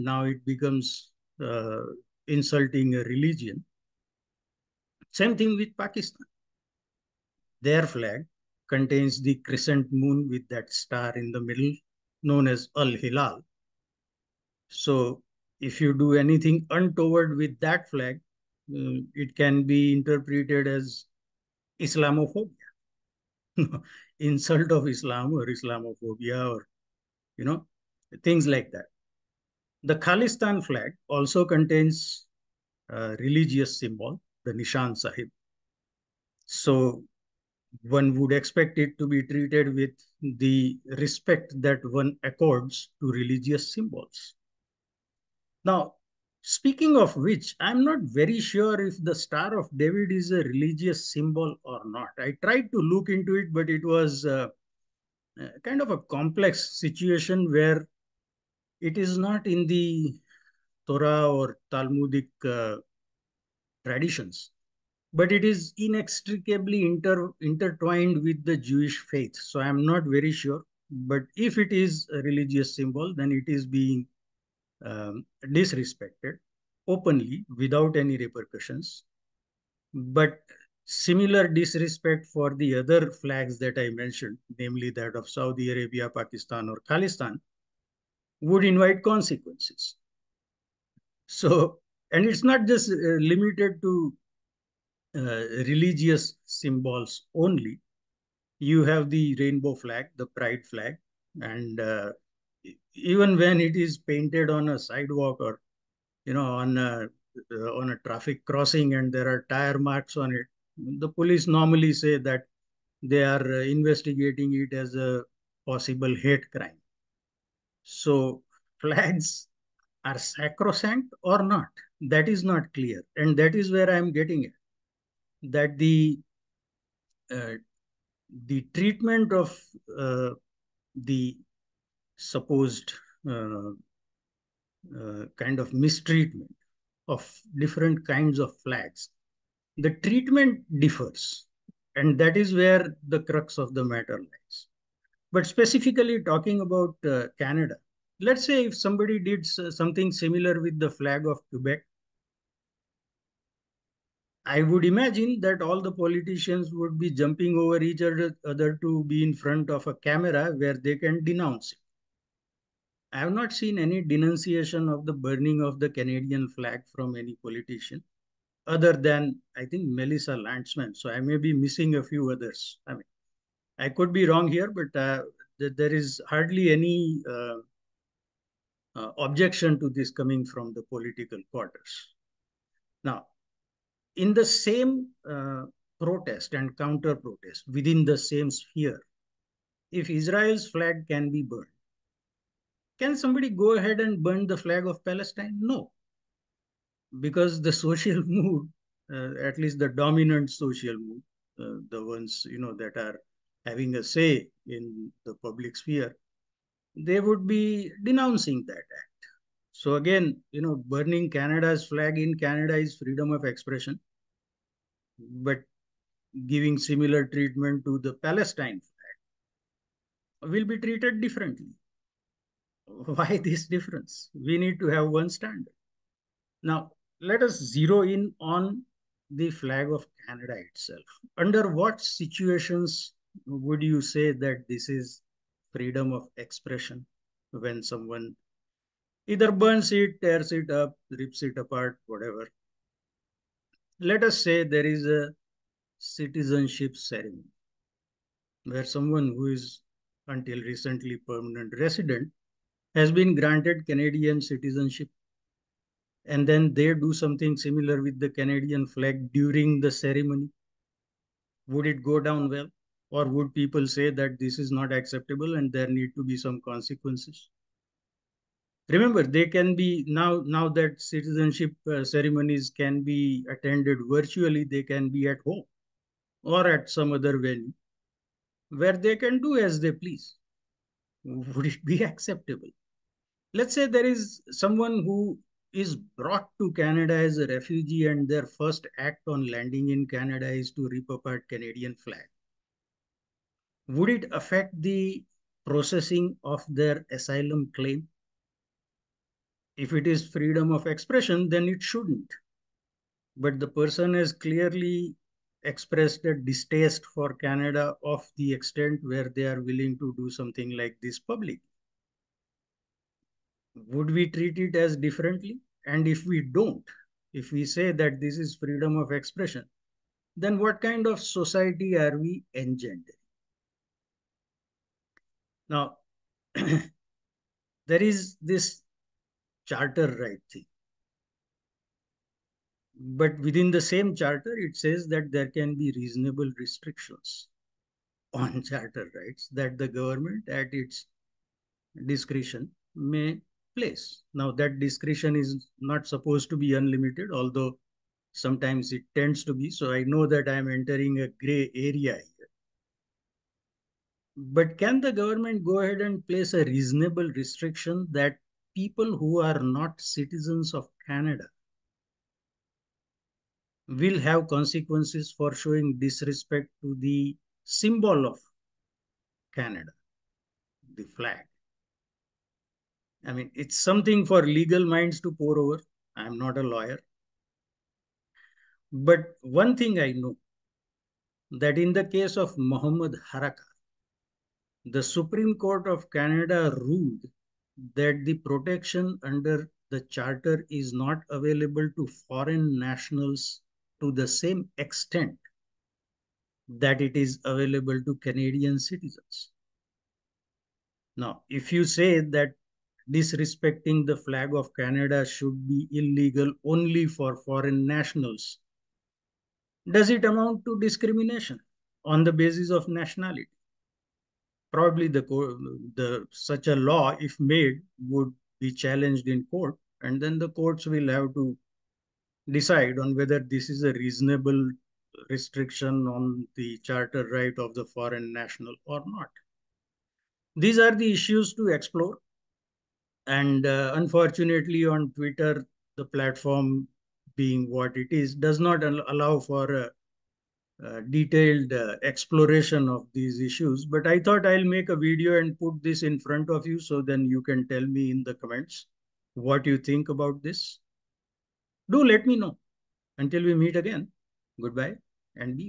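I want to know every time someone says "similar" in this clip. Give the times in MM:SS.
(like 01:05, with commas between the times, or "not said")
01:20, 02:30, 03:36, 04:17.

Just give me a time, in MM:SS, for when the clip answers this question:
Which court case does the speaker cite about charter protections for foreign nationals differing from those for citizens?
06:22.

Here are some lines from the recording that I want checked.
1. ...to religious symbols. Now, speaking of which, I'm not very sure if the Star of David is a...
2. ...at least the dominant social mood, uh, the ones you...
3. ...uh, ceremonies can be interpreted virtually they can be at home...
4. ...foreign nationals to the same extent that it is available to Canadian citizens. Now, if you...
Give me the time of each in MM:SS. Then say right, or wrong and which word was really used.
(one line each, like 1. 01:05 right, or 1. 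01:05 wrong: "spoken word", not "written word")
1. 00:43 right
2. 03:19 right
3. 04:31 wrong: "attended", not "interpreted"
4. 06:32 right.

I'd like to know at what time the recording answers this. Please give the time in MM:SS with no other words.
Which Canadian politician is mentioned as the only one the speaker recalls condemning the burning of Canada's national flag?
02:49.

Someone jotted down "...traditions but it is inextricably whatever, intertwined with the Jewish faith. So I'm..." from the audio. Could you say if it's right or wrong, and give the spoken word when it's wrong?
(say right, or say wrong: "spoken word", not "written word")
wrong: "inter", not "whatever".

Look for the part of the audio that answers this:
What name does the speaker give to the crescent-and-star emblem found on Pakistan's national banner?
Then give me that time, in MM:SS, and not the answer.
00:12.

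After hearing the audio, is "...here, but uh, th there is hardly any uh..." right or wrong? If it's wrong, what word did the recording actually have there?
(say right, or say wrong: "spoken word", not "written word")
right.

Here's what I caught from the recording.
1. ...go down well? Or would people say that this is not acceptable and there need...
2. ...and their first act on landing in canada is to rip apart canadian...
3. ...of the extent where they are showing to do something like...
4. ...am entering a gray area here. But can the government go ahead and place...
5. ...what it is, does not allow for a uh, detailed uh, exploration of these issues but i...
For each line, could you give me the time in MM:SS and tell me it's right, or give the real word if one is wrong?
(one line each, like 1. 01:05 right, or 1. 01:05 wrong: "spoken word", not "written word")
1. 04:22 right
2. 04:48 right
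3. 05:08 wrong: "willing", not "showing"
4. 05:50 right
5. 07:17 right.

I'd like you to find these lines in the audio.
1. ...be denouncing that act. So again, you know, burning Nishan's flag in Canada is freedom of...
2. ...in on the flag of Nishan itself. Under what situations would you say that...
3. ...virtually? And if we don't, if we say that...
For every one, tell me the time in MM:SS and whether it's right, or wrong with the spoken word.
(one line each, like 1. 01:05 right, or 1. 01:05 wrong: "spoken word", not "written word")
1. 03:27 wrong: "Canada", not "Nishan"
2. 03:48 wrong: "Canada", not "Nishan"
3. 05:14 wrong: "differently", not "virtually".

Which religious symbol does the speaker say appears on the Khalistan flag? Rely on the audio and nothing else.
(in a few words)
Nishan Sahib.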